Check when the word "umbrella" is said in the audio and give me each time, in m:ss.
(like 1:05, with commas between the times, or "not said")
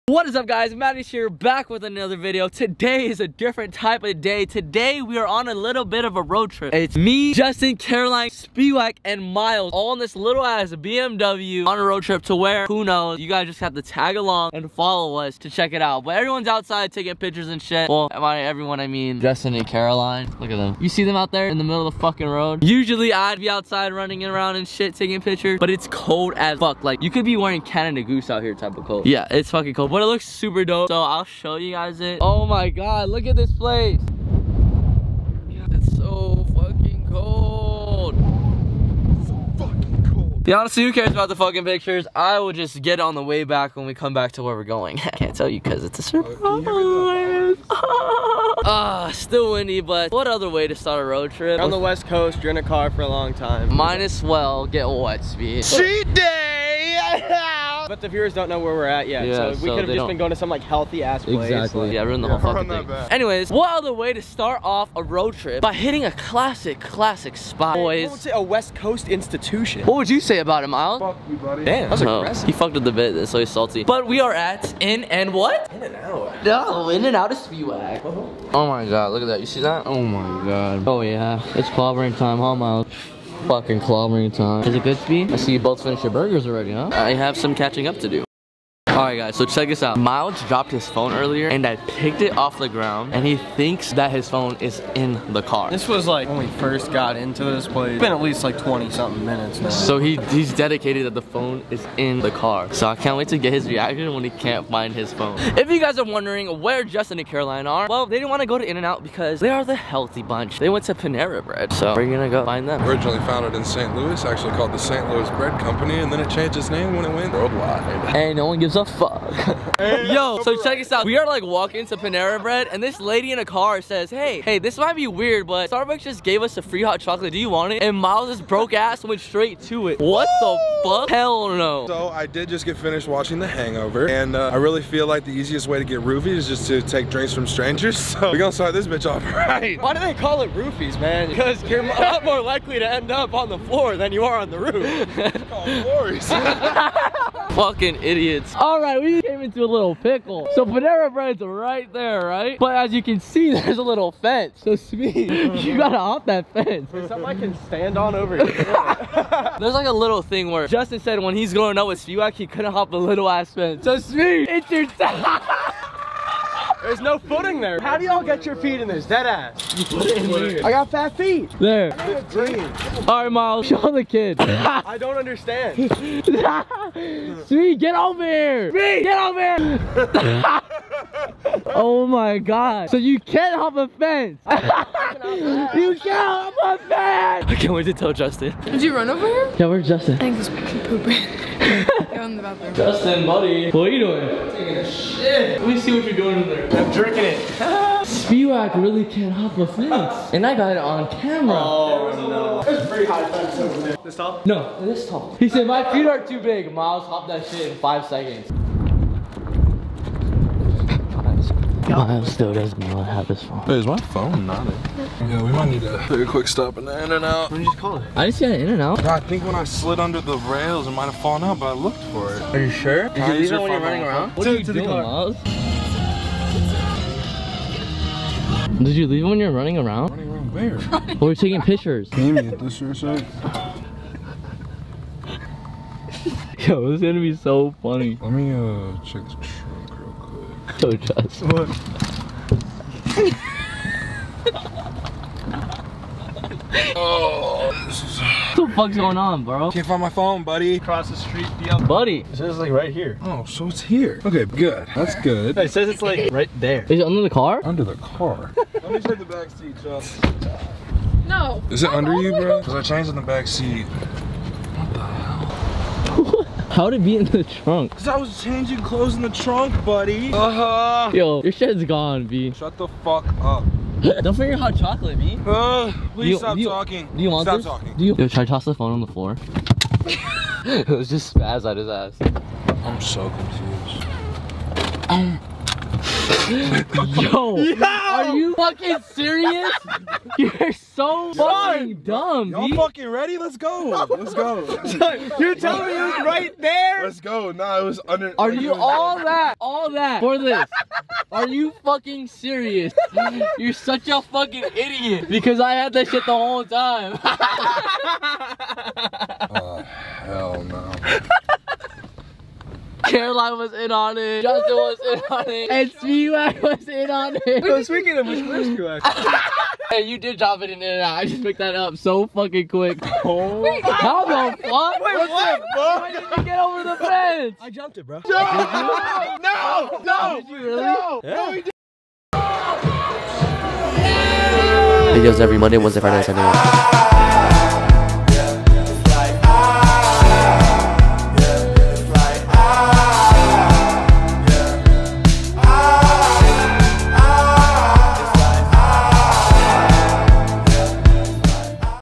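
not said.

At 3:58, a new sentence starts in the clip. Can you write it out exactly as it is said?
Let me uh check so trust.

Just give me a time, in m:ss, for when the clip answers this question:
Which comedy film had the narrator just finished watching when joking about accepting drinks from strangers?
2:13.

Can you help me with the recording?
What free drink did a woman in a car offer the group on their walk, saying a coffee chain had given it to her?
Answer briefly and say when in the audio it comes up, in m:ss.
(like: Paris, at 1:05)
hot chocolate, at 2:06.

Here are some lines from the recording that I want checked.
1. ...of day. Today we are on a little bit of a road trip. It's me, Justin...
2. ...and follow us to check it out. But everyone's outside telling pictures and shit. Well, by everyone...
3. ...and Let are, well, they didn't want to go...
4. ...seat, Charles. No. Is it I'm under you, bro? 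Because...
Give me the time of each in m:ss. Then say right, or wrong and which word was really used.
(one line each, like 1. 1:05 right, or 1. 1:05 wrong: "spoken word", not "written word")
1. 0:04 right
2. 0:14 wrong: "taking", not "telling"
3. 1:47 wrong: "Caroline", not "Let"
4. 4:19 right.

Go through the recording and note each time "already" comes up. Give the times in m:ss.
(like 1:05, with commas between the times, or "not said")
1:26.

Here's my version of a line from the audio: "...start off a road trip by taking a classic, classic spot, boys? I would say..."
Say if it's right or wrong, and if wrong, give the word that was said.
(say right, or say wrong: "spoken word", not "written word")
wrong: "hitting", not "taking".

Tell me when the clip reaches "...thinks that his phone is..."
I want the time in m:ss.
1:33.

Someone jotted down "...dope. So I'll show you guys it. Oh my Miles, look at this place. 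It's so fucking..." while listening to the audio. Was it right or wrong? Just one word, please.
wrong.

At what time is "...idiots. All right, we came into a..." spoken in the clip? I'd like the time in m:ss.
2:28.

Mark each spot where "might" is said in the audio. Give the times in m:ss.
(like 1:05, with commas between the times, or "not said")
0:53, 2:04, 3:35, 3:40.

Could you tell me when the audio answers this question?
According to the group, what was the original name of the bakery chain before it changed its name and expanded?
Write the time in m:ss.
1:54.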